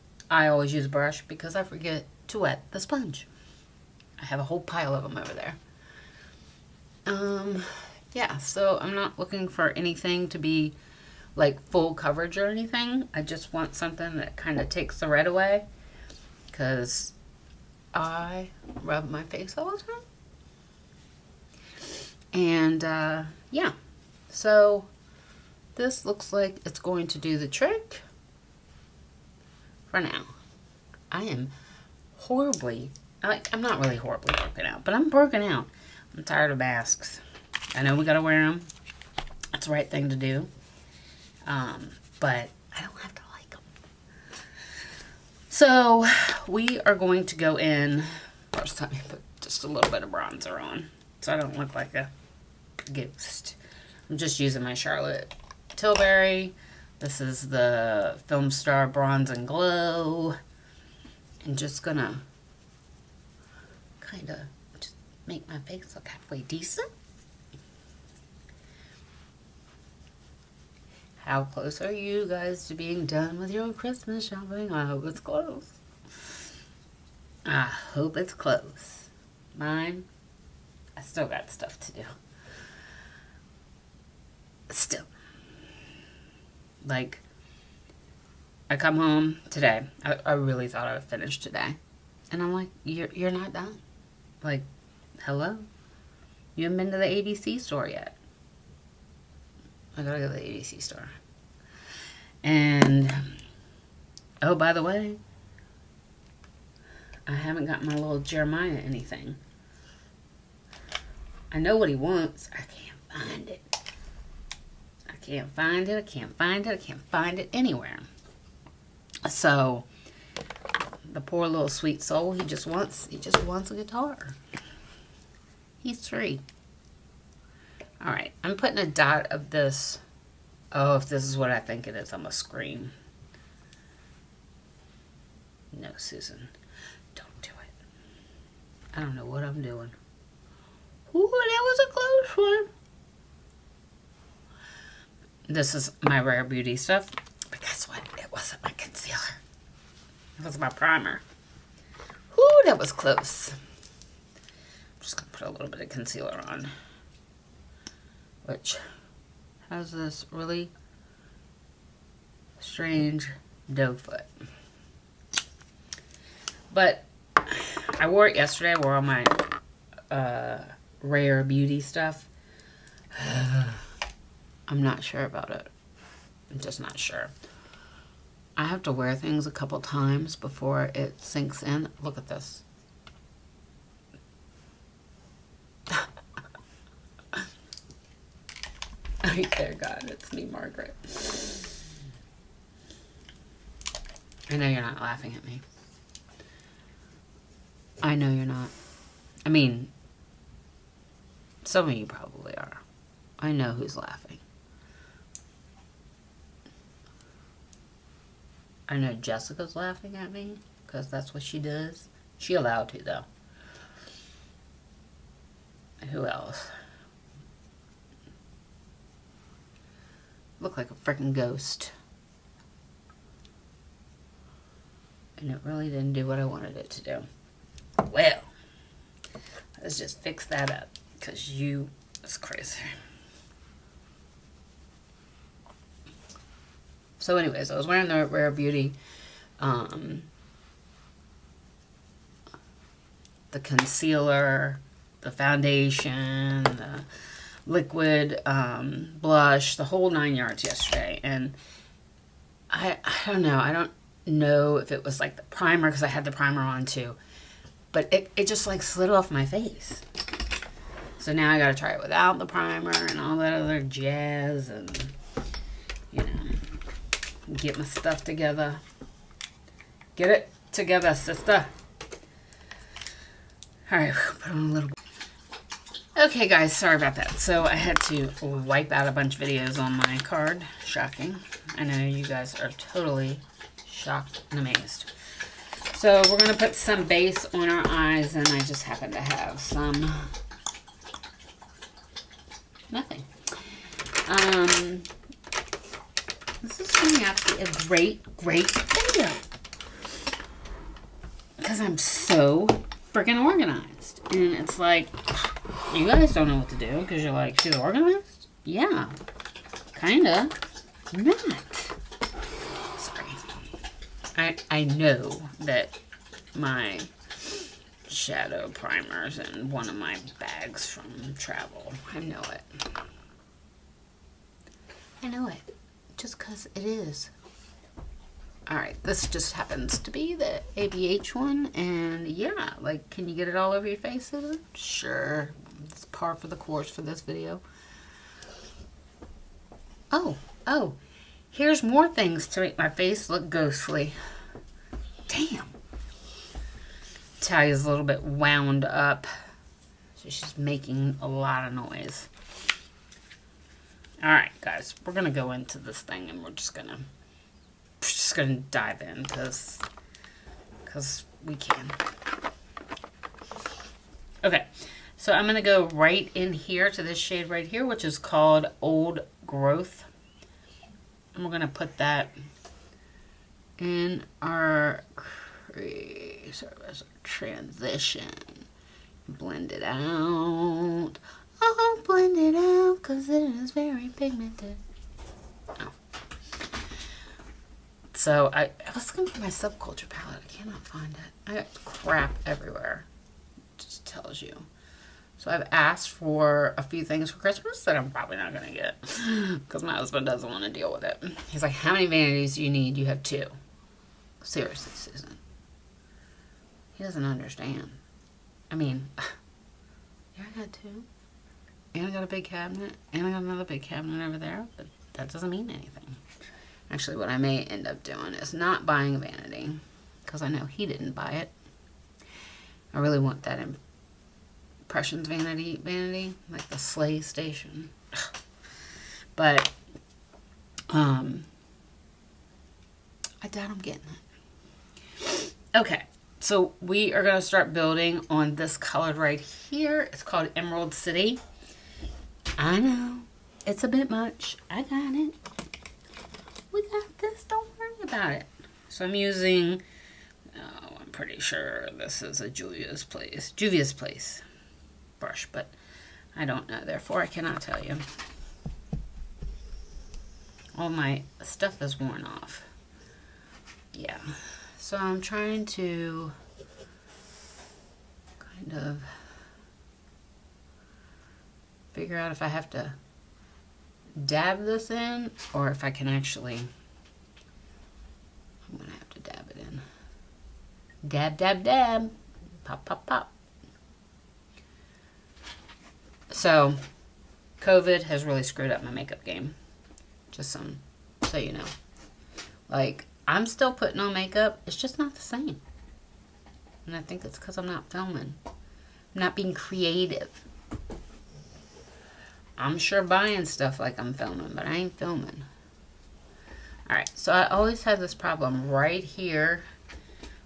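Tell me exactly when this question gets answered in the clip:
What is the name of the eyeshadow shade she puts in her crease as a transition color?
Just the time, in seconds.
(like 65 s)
368 s.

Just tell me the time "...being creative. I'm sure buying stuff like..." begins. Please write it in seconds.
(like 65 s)
499 s.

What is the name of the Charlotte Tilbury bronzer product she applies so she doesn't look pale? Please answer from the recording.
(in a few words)
Film Star Bronze and Glow.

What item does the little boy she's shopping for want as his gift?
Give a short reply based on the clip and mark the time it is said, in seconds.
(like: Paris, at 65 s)
A guitar, at 123 s.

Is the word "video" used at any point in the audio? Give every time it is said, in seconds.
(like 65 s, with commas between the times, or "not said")
279 s, 298 s, 337 s.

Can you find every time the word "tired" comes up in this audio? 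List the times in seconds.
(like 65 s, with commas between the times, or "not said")
36 s.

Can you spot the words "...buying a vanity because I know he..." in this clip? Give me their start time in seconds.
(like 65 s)
418 s.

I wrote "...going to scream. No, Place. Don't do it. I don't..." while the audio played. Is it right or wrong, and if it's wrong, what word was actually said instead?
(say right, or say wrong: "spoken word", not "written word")
wrong: "Susan", not "Place".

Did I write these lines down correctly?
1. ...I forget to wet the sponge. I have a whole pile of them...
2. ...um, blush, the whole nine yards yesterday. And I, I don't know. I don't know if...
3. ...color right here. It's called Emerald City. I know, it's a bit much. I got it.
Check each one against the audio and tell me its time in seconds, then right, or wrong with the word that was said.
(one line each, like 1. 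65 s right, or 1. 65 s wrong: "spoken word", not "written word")
1. 1 s right
2. 248 s right
3. 438 s right.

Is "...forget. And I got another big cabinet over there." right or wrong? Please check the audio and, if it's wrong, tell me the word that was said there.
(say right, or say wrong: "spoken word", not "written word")
wrong: "cabinet", not "forget".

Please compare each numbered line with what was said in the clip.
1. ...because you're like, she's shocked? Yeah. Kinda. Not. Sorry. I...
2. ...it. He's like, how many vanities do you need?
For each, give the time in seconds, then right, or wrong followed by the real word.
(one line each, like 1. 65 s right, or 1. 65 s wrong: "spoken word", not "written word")
1. 307 s wrong: "organized", not "shocked"
2. 401 s right.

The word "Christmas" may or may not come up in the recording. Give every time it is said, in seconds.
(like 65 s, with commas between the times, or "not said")
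73 s, 397 s.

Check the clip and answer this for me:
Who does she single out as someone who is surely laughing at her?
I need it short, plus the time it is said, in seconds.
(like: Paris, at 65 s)
Jessica, at 209 s.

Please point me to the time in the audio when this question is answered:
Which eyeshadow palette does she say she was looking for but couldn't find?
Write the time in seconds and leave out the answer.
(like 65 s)
389 s.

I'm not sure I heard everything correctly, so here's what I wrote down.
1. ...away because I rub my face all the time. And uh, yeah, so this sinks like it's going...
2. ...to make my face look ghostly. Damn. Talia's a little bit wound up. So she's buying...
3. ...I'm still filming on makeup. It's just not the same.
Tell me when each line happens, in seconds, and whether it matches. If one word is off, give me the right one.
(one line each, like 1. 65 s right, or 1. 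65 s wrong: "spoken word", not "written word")
1. 15 s wrong: "looks", not "sinks"
2. 342 s wrong: "making", not "buying"
3. 493 s wrong: "putting", not "filming".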